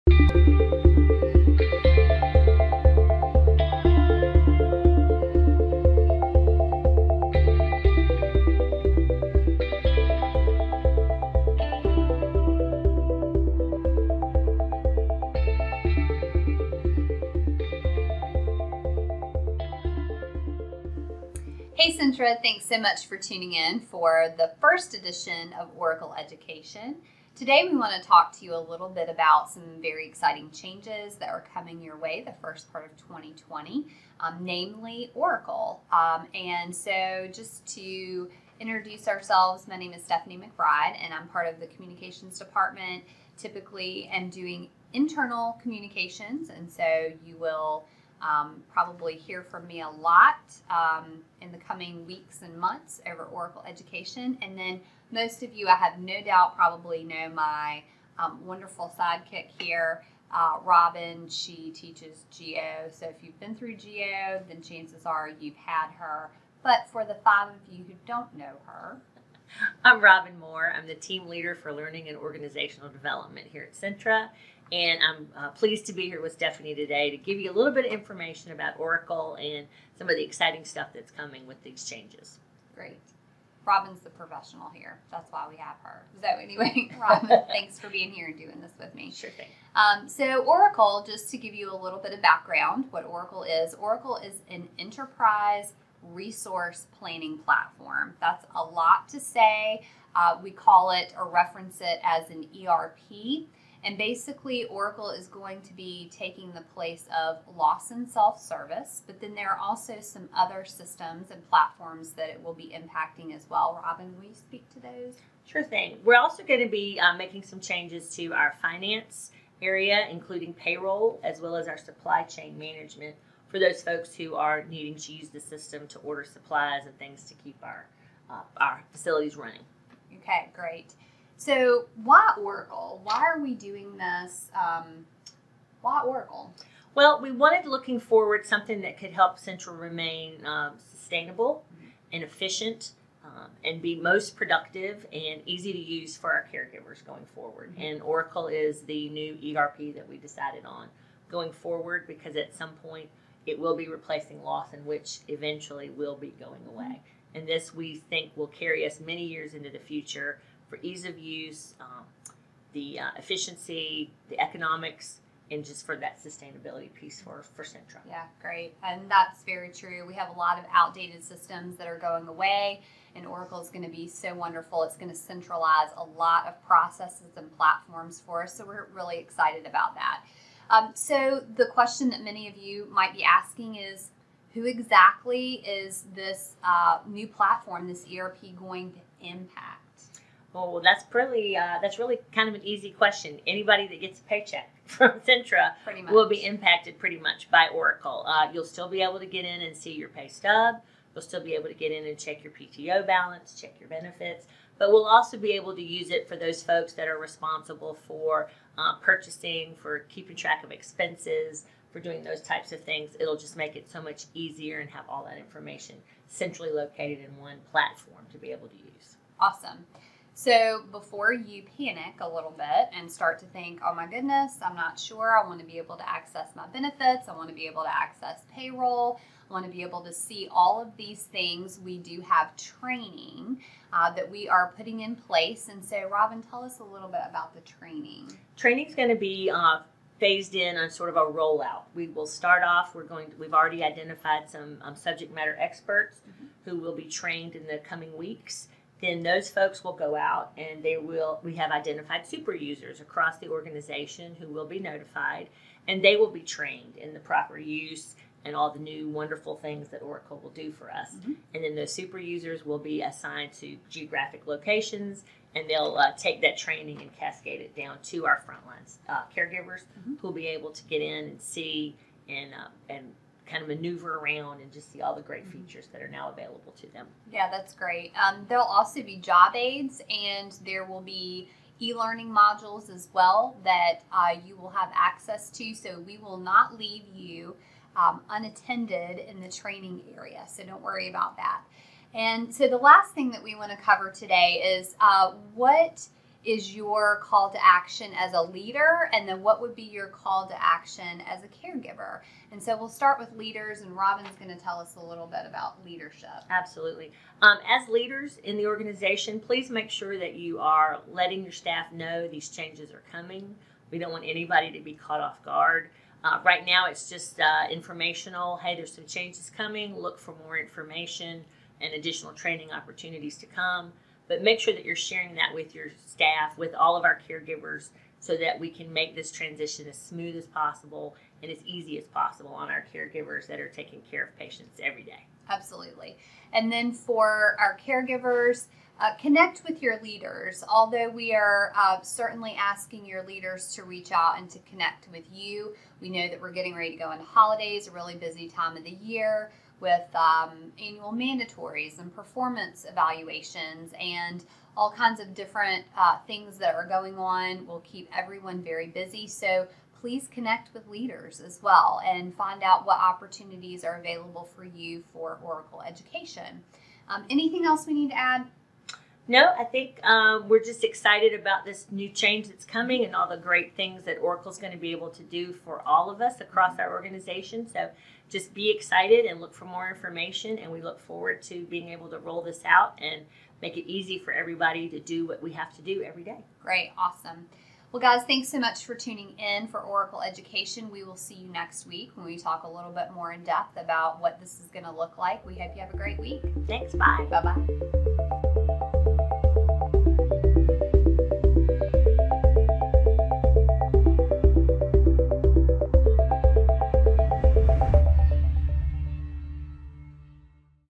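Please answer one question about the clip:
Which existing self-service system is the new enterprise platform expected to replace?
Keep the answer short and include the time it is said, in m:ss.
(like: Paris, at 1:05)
Lawson Self Service, at 1:47.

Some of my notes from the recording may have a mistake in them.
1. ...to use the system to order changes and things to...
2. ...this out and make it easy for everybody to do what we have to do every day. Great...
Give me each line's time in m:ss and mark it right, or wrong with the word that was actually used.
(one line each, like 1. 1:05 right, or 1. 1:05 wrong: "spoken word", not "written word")
1. 2:04 wrong: "supplies", not "changes"
2. 6:22 right.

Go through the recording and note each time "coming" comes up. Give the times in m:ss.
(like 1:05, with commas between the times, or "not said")
0:31, 0:51, 1:21, 4:07, 5:13, 5:19, 6:12.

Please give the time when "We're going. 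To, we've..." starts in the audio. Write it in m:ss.
4:02.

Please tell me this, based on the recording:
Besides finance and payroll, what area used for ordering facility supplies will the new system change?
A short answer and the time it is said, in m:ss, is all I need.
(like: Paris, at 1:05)
supply chain management, at 2:01.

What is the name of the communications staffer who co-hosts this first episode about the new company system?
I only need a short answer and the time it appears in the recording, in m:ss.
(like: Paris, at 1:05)
Stephanie McBride, at 0:40.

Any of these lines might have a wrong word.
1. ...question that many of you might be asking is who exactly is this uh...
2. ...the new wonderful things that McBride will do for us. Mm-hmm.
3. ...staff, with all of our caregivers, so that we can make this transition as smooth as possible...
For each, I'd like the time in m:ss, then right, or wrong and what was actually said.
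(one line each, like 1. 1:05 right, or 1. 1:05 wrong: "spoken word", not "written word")
1. 3:01 right
2. 4:18 wrong: "Oracle", not "McBride"
3. 5:26 right.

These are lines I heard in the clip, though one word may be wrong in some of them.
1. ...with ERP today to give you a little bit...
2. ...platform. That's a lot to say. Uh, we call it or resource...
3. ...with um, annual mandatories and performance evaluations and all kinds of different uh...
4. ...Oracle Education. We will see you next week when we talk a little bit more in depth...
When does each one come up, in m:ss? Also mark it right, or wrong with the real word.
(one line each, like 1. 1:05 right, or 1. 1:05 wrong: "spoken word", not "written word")
1. 1:16 wrong: "Stephanie", not "ERP"
2. 1:37 wrong: "reference", not "resource"
3. 5:49 right
4. 6:29 right.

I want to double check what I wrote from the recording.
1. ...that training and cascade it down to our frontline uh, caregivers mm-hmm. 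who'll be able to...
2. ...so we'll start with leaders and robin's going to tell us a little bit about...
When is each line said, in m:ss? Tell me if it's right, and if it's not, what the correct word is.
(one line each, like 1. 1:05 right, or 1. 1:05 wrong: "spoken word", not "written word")
1. 4:26 right
2. 5:02 right.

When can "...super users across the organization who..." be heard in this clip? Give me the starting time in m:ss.
4:12.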